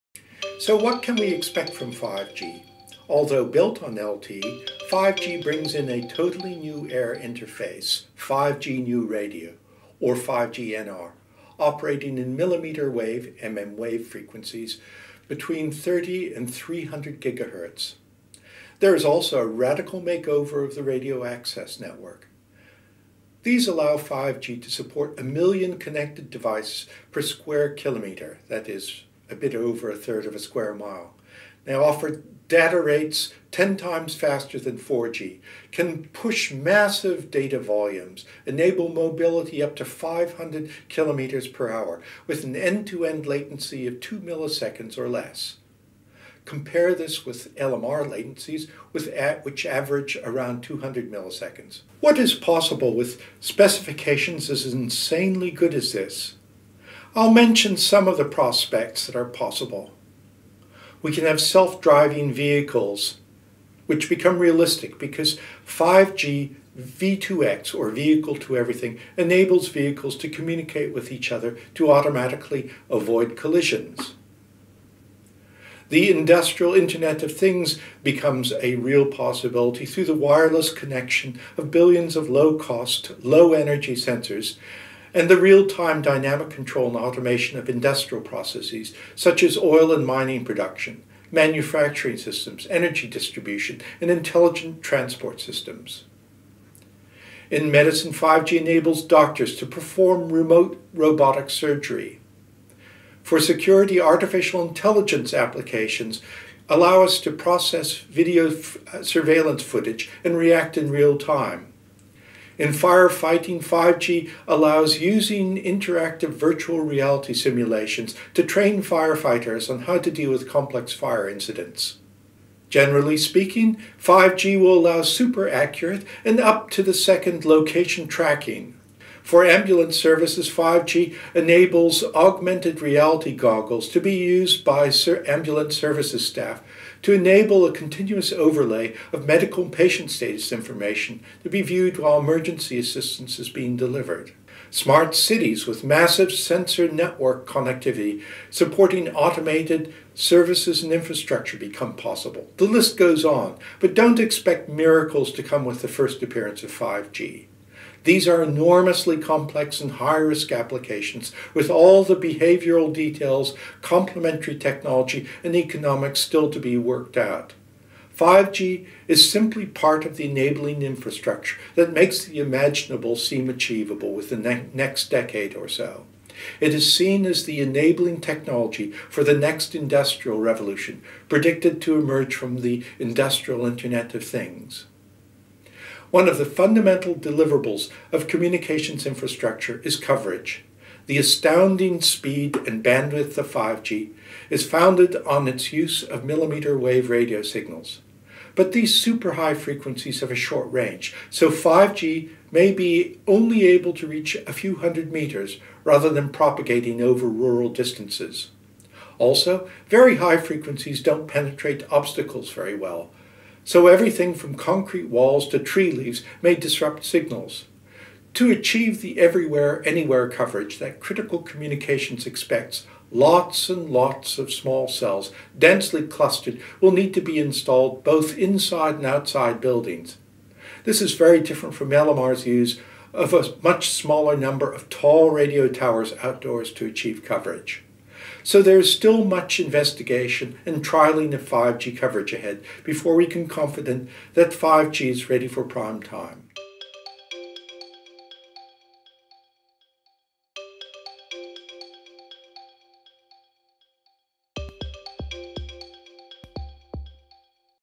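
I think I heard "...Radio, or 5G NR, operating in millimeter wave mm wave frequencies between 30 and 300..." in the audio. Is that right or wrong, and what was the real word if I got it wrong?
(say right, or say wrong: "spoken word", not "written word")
right.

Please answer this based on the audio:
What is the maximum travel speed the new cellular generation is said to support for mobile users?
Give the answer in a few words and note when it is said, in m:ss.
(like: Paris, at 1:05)
500 kilometers per hour, at 0:39.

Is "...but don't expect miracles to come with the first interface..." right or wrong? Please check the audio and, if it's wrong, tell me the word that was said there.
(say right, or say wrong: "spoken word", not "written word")
wrong: "appearance", not "interface".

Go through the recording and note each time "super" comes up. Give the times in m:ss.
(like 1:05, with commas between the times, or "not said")
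2:05, 3:18.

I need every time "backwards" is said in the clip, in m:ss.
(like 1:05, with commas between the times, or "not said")
not said.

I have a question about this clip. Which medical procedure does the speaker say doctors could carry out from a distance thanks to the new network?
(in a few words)
remote robotic surgery.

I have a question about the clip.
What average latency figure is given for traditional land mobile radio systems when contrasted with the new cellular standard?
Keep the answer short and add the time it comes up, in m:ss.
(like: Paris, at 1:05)
200 milliseconds, at 0:50.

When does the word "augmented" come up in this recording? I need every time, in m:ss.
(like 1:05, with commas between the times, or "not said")
2:12.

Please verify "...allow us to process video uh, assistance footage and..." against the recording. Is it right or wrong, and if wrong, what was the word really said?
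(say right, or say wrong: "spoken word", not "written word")
wrong: "surveillance", not "assistance".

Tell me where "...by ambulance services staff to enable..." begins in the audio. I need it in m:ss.
2:14.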